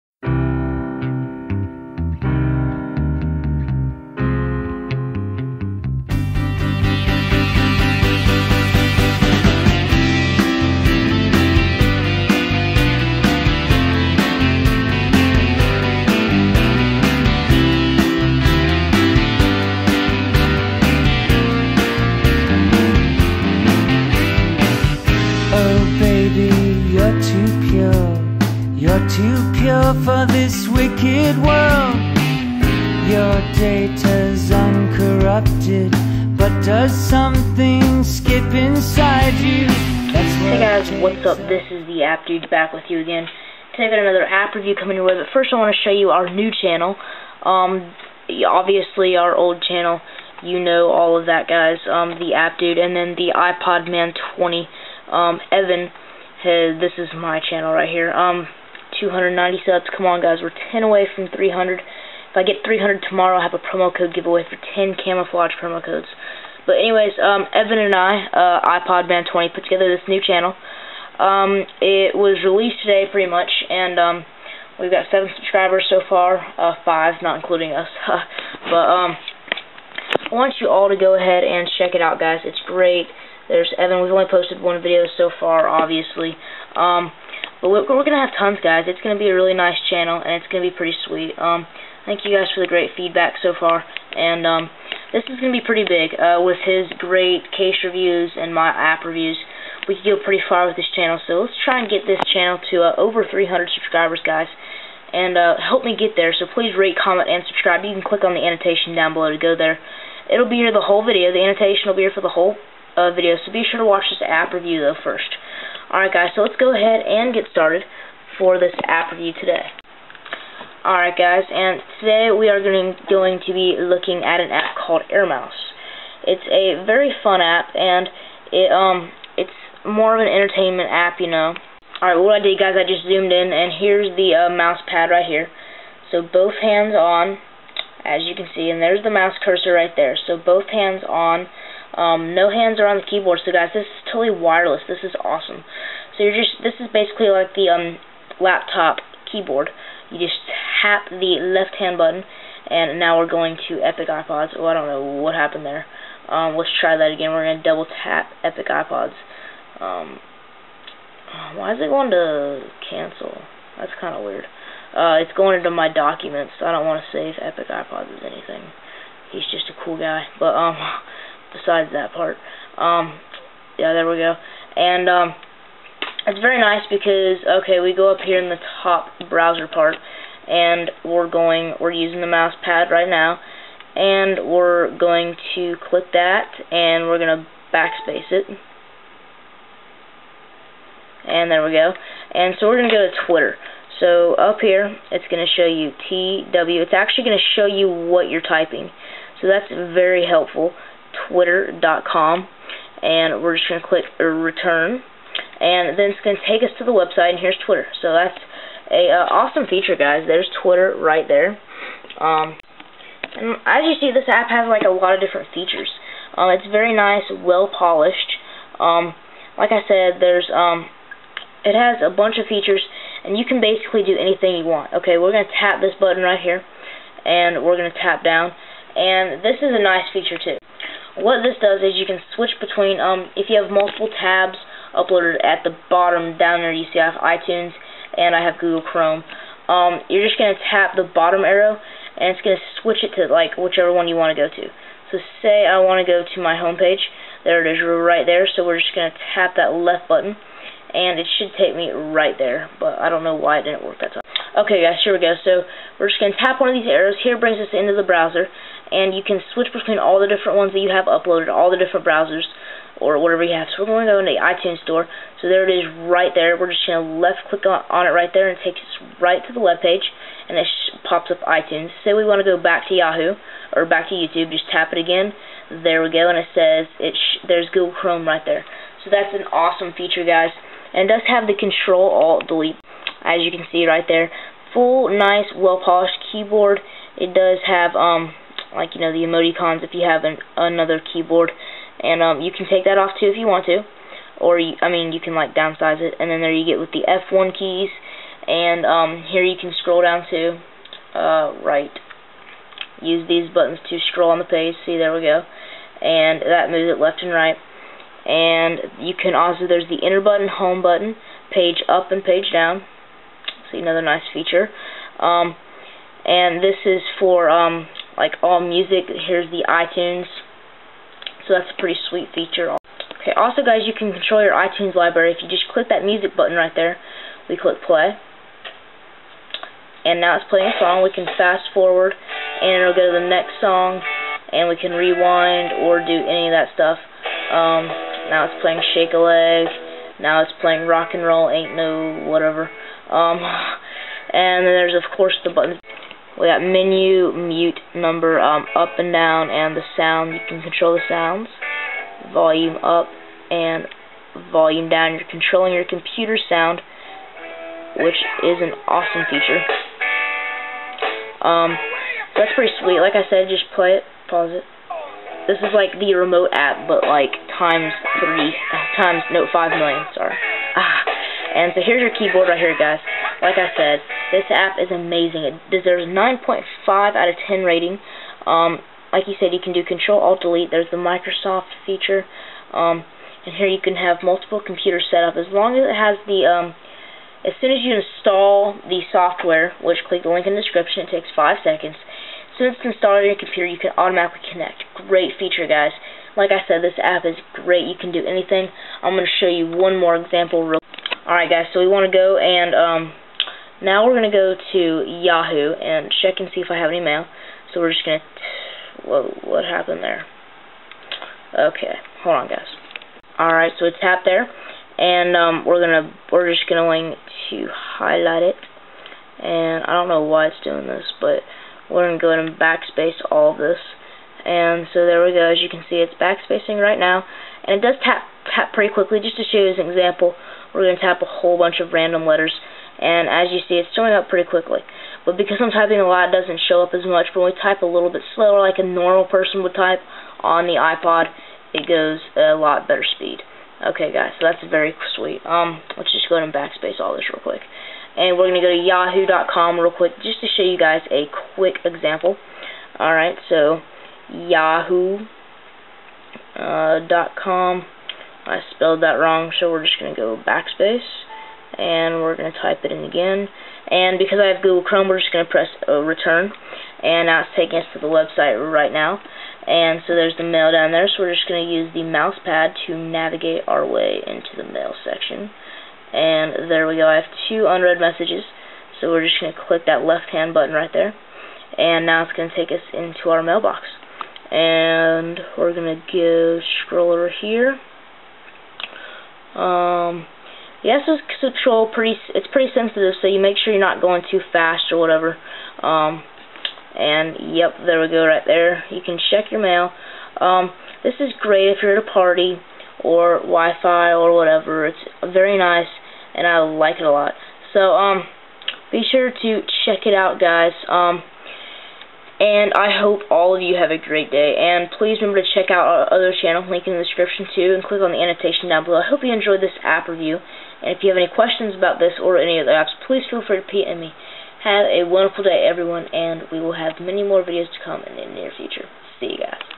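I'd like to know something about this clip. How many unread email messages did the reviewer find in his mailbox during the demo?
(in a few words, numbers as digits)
2.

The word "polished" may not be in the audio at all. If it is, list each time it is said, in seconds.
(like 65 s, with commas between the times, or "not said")
217 s, 285 s.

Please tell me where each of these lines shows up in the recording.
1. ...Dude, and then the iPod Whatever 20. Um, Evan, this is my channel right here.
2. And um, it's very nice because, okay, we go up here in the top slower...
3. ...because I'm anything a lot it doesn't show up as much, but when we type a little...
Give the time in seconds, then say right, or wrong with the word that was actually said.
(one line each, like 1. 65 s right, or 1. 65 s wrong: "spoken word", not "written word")
1. 52 s wrong: "Man", not "Whatever"
2. 174 s wrong: "browser", not "slower"
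3. 435 s wrong: "typing", not "anything".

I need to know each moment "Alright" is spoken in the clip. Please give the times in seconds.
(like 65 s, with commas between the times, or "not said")
115 s, 120 s, 132 s, 401 s, 413 s, 453 s.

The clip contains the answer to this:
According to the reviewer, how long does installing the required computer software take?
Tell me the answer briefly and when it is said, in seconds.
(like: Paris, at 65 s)
5 seconds, at 391 s.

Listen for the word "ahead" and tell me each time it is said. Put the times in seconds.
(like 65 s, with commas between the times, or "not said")
81 s, 116 s, 422 s, 446 s.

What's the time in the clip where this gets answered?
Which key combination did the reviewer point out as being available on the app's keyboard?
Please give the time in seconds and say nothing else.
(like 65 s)
281 s.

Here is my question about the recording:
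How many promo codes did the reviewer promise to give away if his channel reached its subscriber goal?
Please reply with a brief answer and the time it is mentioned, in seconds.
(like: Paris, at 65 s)
10, at 64 s.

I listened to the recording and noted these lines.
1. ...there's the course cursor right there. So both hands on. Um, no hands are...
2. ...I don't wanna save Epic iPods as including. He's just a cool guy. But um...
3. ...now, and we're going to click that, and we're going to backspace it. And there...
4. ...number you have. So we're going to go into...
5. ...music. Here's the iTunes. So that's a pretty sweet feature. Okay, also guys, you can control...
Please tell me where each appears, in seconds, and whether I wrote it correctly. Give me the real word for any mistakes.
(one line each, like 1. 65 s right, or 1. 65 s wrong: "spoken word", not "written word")
1. 138 s wrong: "mouse", not "course"
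2. 166 s wrong: "anything", not "including"
3. 183 s right
4. 263 s wrong: "whatever", not "number"
5. 318 s right.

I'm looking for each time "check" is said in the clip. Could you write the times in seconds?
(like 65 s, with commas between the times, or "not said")
81 s, 406 s, 499 s, 509 s, 515 s.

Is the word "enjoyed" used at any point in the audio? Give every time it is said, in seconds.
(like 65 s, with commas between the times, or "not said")
519 s.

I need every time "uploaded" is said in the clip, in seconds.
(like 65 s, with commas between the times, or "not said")
234 s, 261 s.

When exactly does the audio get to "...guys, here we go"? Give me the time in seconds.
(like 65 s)
254 s.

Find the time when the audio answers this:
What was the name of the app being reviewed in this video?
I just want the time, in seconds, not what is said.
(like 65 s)
125 s.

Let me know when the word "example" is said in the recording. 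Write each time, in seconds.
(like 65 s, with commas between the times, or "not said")
400 s, 429 s, 451 s.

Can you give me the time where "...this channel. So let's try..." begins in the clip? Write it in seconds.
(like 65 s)
100 s.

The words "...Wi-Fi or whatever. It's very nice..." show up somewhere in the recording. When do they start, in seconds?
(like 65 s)
503 s.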